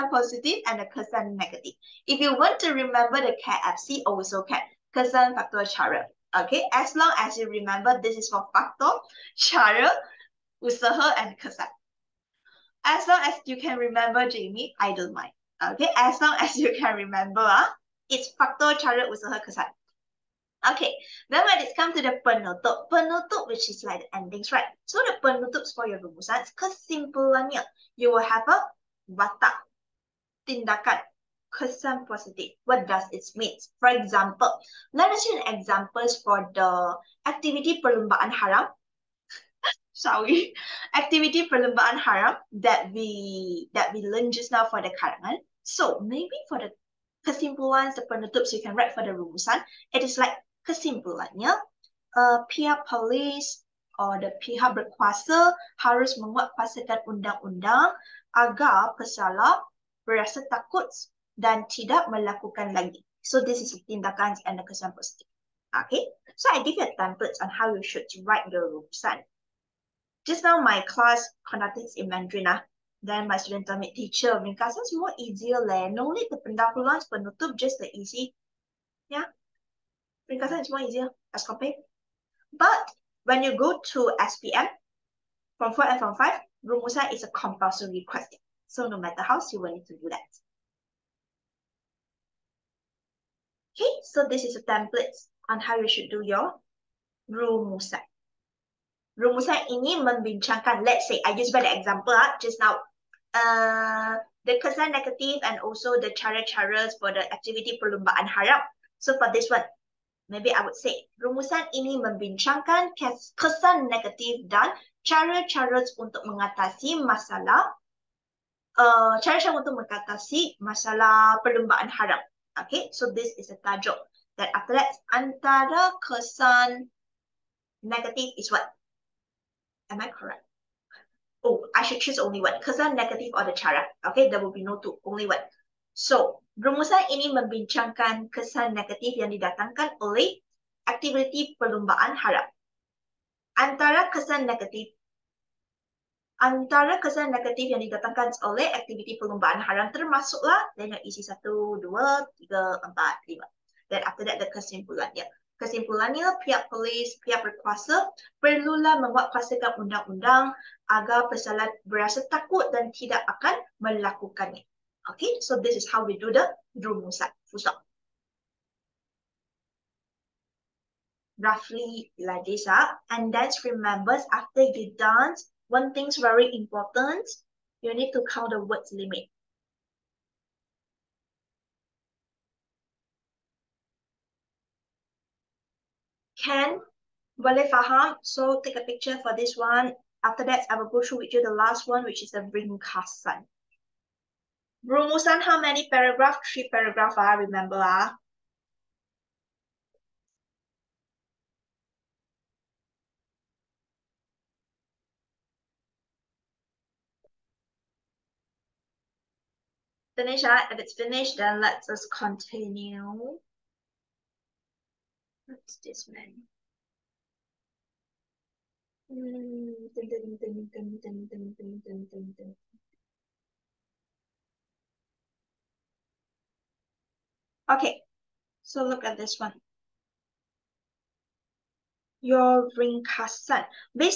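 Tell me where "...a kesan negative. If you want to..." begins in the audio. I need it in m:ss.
0:00.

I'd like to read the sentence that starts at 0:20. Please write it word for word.
Okay, then when it's come to the penutup, penutup which is like the endings, right?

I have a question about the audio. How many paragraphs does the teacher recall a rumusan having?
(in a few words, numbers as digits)
3.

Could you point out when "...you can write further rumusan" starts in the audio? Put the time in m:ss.
0:48.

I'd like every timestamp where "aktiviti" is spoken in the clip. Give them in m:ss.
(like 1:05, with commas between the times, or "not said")
2:20, 2:28.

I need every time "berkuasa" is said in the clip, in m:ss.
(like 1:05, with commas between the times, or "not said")
0:54, 2:37.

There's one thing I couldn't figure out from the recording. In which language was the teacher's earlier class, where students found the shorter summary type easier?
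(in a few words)
Mandarin.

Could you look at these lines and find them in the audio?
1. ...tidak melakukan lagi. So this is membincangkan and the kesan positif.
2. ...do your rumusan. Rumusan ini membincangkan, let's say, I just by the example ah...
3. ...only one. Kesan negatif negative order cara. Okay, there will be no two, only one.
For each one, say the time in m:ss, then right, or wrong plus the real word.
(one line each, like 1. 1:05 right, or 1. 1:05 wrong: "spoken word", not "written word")
1. 1:01 wrong: "tindakan", not "membincangkan"
2. 1:36 right
3. 2:12 right.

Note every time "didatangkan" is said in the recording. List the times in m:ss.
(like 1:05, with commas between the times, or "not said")
2:19, 2:27.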